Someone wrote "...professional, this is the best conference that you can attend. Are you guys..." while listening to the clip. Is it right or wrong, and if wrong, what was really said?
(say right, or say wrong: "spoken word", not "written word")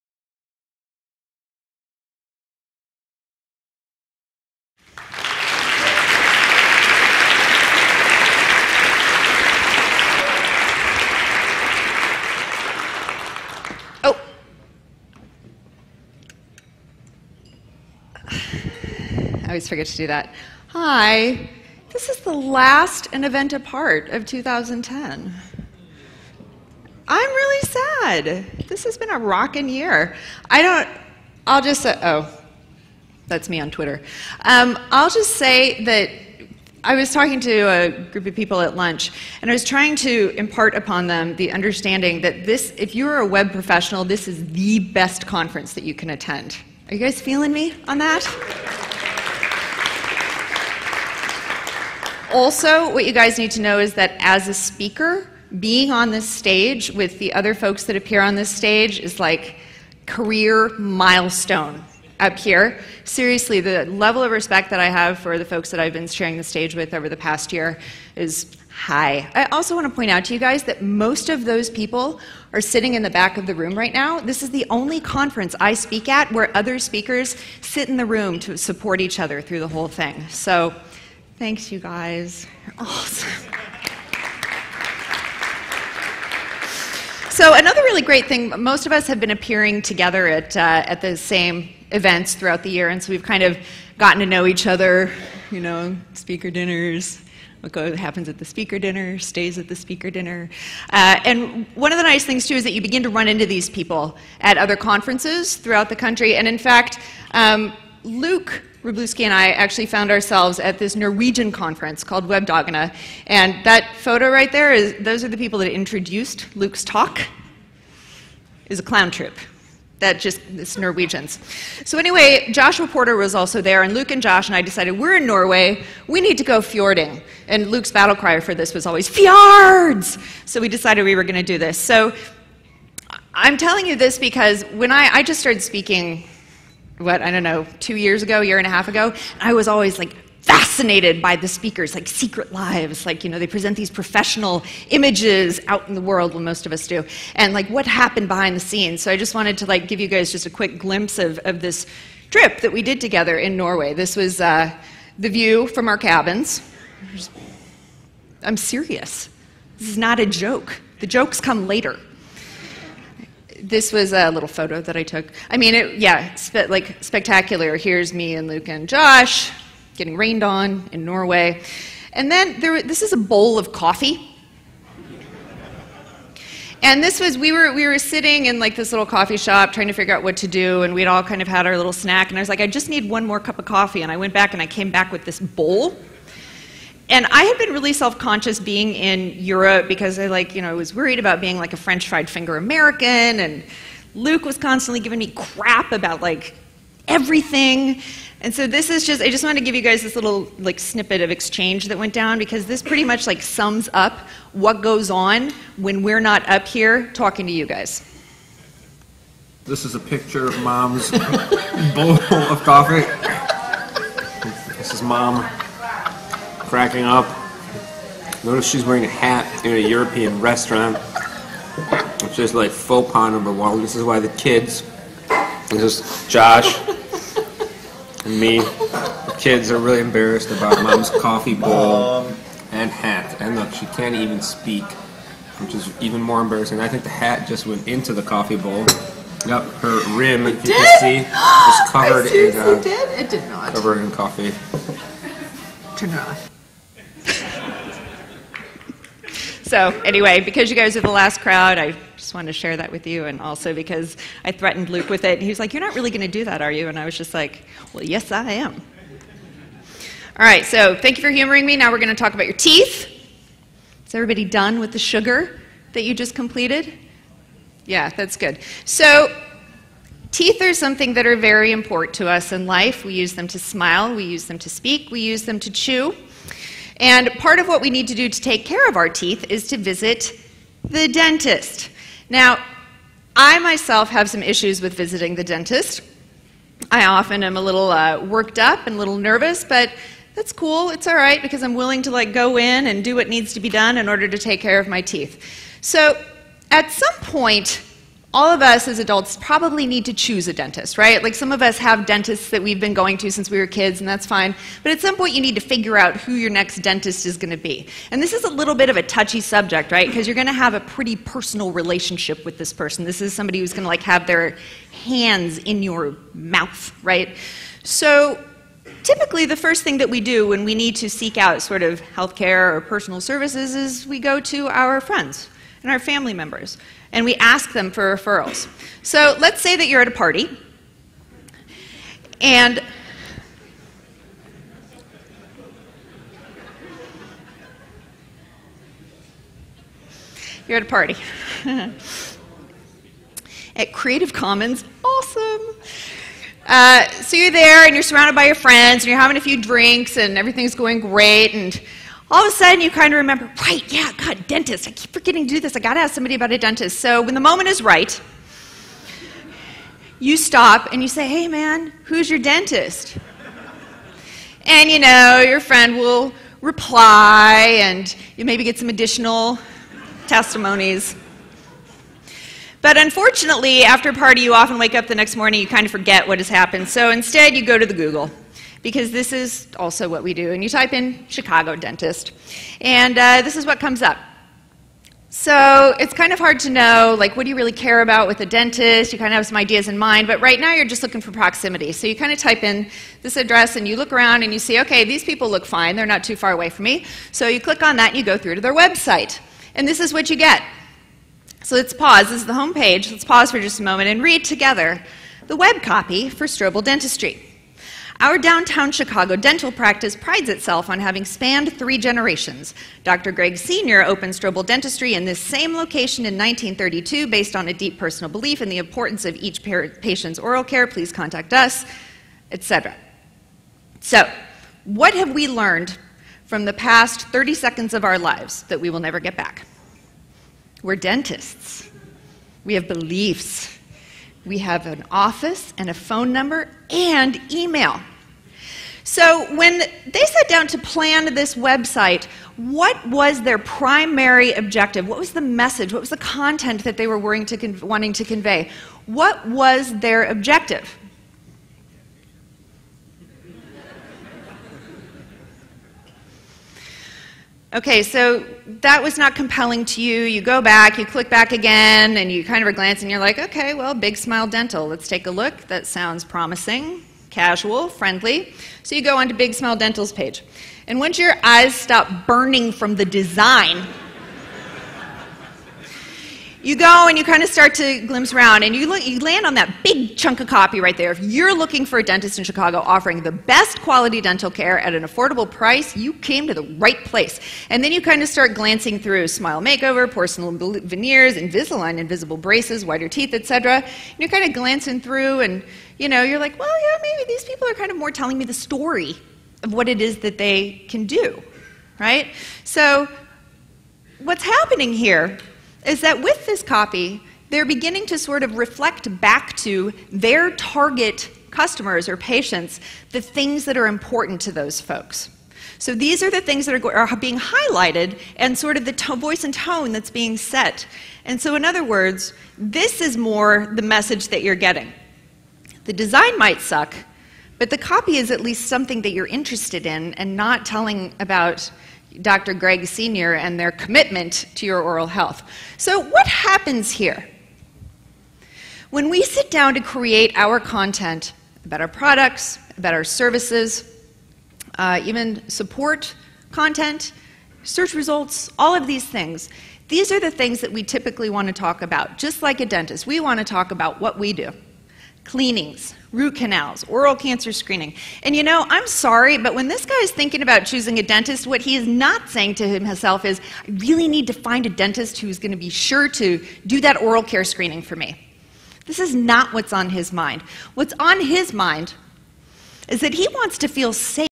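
right.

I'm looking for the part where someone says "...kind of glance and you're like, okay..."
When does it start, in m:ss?
7:42.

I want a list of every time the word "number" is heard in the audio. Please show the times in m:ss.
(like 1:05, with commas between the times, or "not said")
3:43, 7:16.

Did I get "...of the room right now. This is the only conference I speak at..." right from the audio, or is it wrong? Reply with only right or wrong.
right.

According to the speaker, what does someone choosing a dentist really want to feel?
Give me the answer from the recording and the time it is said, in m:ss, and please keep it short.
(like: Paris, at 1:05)
Safe, at 9:33.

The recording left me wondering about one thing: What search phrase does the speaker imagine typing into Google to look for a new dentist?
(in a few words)
Chicago dentist.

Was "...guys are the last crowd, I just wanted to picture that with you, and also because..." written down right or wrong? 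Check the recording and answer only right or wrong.
wrong.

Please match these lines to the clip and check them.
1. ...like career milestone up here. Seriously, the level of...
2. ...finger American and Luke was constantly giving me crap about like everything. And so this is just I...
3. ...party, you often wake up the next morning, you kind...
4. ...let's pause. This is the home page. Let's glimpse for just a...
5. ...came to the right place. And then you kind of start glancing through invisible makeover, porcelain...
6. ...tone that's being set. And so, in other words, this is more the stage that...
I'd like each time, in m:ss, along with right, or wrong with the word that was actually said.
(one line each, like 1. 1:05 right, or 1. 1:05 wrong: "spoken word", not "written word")
1. 0:59 right
2. 3:12 right
3. 6:14 right
4. 6:41 wrong: "pause", not "glimpse"
5. 8:06 wrong: "smile", not "invisible"
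6. 8:39 wrong: "message", not "stage".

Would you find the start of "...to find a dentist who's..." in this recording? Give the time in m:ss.
9:24.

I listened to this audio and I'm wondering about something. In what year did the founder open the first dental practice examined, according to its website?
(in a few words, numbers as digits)
1932.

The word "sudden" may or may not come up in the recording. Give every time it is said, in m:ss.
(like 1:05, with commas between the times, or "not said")
5:52.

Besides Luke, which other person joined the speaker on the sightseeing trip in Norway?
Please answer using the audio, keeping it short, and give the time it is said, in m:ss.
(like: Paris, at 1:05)
Joshua Porter, at 2:02.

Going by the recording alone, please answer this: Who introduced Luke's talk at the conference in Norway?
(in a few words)
A clown troupe.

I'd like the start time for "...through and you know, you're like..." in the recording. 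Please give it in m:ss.
8:15.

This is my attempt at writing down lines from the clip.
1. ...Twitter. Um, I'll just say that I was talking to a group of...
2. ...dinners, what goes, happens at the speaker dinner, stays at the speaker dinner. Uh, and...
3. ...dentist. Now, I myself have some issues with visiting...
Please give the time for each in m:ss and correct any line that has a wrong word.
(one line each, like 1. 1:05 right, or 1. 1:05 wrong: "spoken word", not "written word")
1. 0:33 right
2. 1:36 right
3. 4:41 right.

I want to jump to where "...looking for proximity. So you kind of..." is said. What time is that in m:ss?
6:31.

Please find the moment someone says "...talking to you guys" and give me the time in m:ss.
3:27.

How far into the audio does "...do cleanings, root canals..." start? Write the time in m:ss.
9:14.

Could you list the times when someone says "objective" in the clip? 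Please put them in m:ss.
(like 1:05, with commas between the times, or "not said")
7:24, 7:30.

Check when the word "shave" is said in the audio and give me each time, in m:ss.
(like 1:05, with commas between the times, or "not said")
not said.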